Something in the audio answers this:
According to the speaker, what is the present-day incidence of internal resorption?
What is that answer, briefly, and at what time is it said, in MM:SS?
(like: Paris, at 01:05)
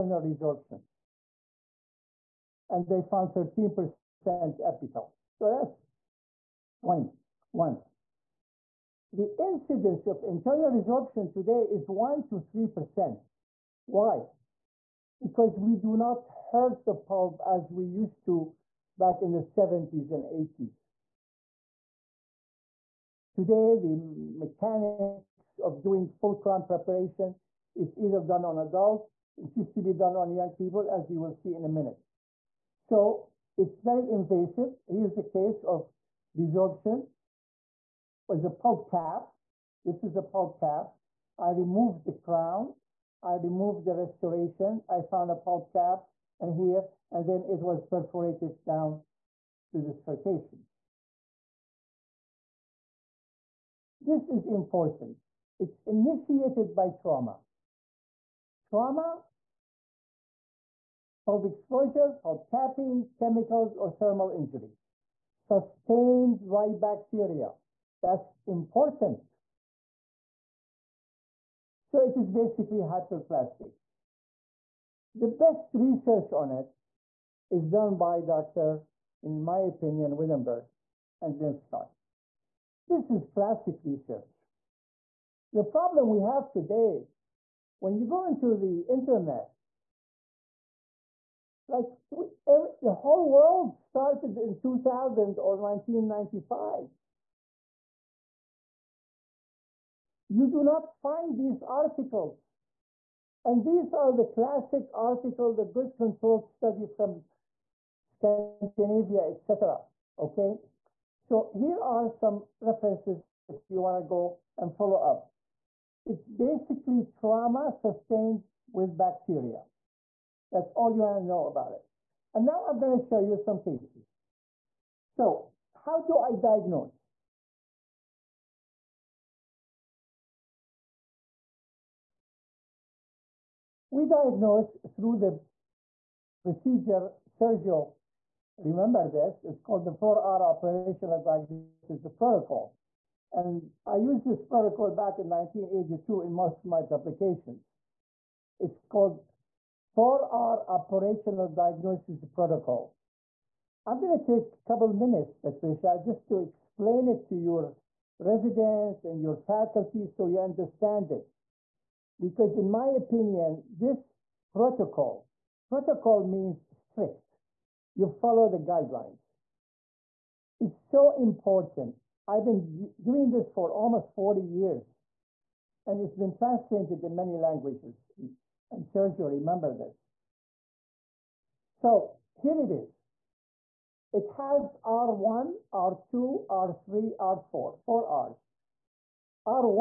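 1 to 3%, at 00:11.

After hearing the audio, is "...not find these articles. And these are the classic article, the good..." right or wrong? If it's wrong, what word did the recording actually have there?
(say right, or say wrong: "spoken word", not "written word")
right.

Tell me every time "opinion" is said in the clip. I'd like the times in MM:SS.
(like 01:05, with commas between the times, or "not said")
01:19, 02:42.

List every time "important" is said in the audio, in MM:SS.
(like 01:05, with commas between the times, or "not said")
00:54, 01:08, 02:51.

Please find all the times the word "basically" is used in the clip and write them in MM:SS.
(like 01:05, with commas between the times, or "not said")
01:12, 01:56.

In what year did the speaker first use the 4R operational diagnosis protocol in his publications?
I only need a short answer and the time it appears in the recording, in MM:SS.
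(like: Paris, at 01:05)
1982, at 02:25.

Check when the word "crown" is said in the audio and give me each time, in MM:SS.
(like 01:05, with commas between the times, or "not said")
00:26, 00:42.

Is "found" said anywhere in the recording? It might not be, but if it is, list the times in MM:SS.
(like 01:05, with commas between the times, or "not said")
00:03, 00:45.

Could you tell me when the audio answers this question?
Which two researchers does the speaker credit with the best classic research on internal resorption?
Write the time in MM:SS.
01:20.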